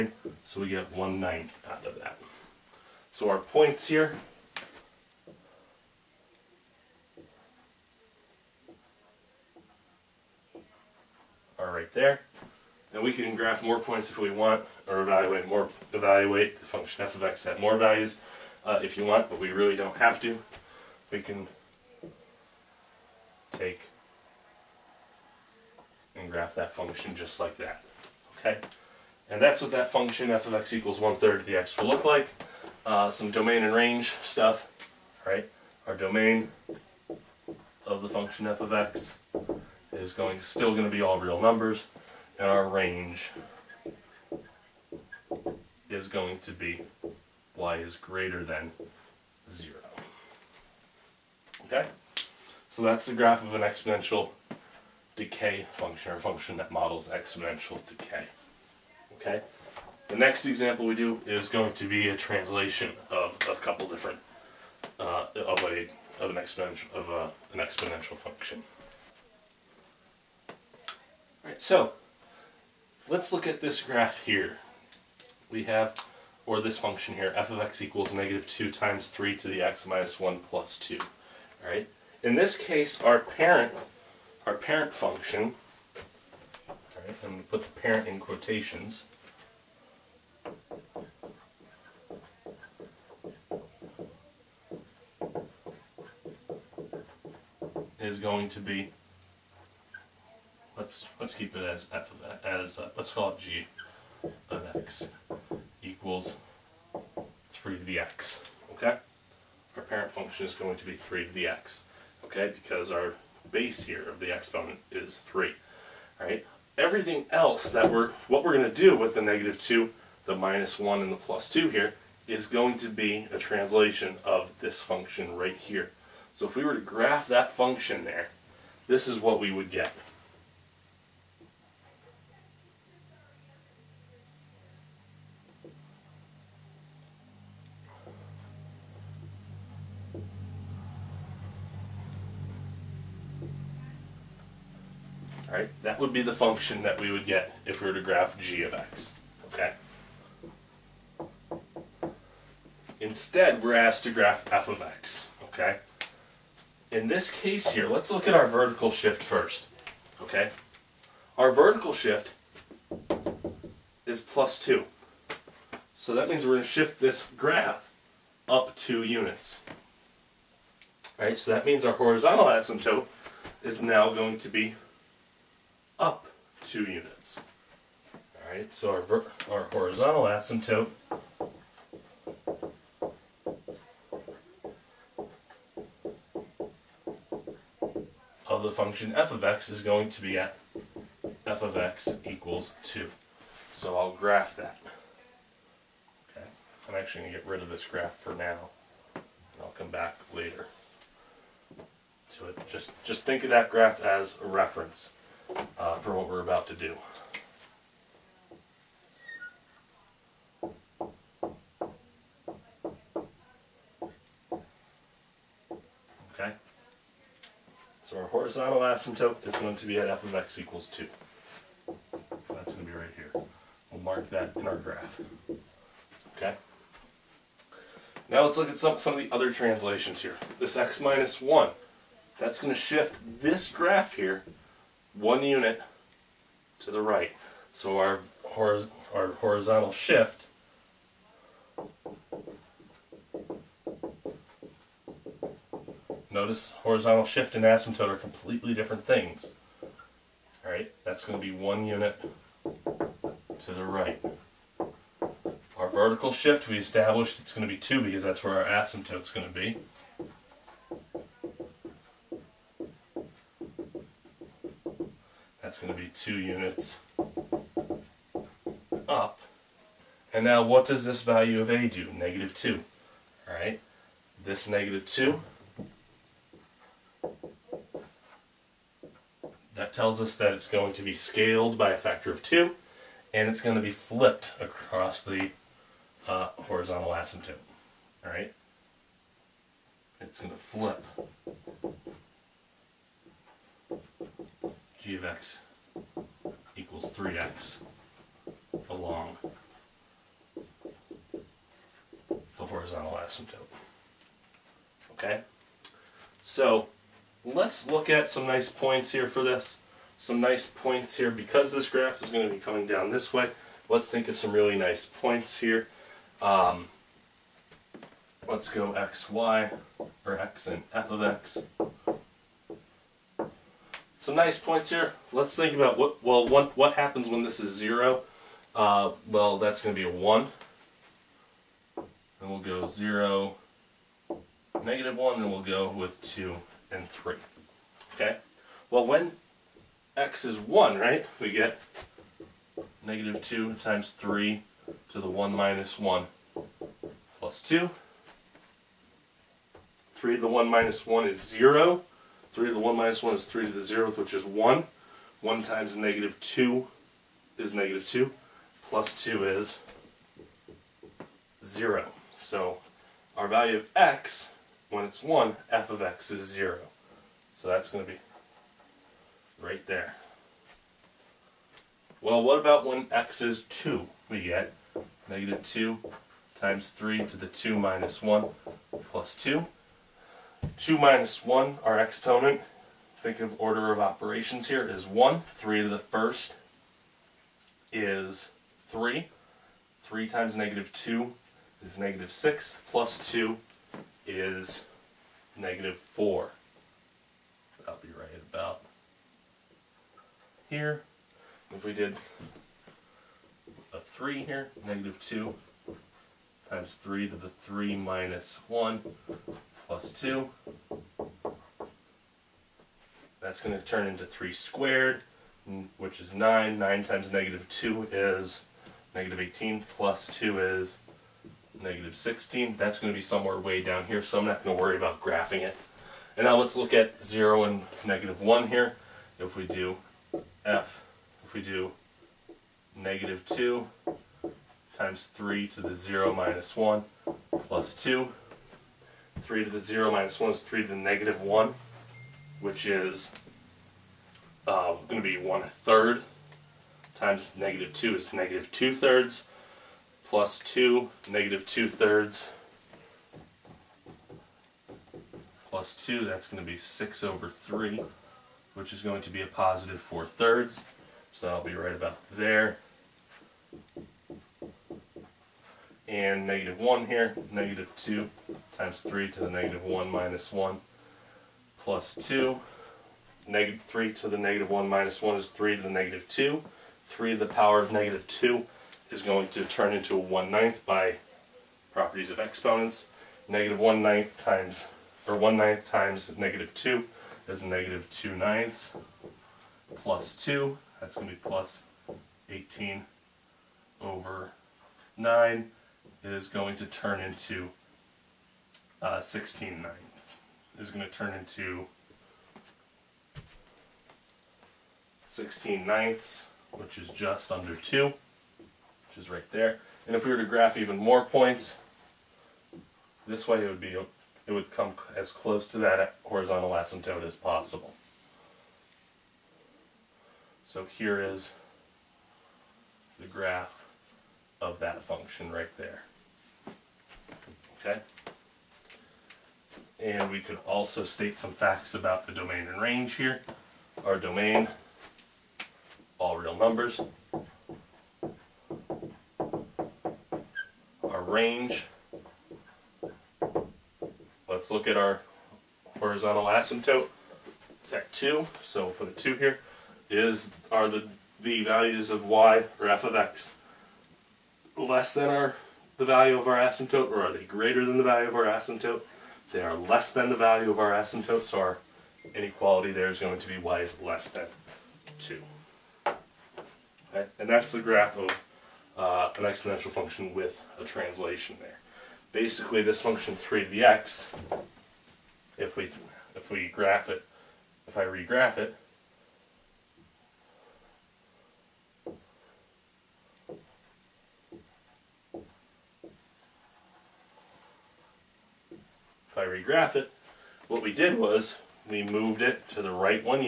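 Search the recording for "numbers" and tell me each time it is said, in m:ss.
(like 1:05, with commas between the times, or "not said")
0:41, 8:56.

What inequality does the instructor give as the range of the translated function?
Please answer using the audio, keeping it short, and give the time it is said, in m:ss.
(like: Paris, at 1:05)
y < 2, at 9:23.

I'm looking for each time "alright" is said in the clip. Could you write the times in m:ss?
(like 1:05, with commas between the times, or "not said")
1:11, 1:21, 1:26, 4:10, 4:33, 4:48.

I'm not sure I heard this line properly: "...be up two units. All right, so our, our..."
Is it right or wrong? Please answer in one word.
right.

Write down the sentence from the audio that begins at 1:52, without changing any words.
Okay, because our base here of the exponent is 3.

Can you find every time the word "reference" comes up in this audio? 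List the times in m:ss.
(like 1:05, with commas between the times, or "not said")
3:24.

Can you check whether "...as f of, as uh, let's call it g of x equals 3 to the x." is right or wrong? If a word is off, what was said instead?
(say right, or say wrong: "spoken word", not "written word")
right.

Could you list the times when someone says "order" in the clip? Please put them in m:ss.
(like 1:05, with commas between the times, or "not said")
6:23.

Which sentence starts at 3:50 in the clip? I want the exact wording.
This x minus 1, that's going to shift this graph here one unit to the right.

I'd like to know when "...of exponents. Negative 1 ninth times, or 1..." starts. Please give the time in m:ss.
8:02.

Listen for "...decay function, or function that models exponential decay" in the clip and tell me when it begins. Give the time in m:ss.
0:55.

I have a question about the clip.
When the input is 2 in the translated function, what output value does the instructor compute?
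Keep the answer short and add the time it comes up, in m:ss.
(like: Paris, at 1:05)
-4, at 6:35.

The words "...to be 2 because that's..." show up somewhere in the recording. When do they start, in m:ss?
4:17.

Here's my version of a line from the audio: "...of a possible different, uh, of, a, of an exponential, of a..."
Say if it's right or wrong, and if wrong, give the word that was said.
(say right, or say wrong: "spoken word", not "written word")
wrong: "couple", not "possible".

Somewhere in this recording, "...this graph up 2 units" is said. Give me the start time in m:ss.
2:46.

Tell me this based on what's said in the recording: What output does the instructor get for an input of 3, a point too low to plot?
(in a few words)
-16.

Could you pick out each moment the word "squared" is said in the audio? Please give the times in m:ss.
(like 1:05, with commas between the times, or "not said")
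6:54.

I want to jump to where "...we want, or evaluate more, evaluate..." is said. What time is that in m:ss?
0:14.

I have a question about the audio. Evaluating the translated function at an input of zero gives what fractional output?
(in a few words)
4/3.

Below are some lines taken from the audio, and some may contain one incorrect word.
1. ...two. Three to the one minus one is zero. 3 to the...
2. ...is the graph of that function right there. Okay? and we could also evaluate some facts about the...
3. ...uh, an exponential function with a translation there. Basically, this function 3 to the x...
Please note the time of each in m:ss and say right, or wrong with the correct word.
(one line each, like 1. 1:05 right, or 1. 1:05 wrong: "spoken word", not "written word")
1. 5:47 right
2. 8:41 wrong: "state", not "evaluate"
3. 9:28 right.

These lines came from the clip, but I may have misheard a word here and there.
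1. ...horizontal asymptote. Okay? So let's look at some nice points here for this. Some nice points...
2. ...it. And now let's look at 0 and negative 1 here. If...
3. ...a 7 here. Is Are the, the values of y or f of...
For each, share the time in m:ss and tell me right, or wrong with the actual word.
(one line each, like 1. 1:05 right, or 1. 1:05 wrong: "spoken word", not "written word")
1. 5:02 right
2. 7:05 right
3. 9:09 wrong: "2", not "7".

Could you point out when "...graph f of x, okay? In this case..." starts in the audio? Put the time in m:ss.
2:34.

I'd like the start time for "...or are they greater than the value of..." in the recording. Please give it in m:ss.
9:17.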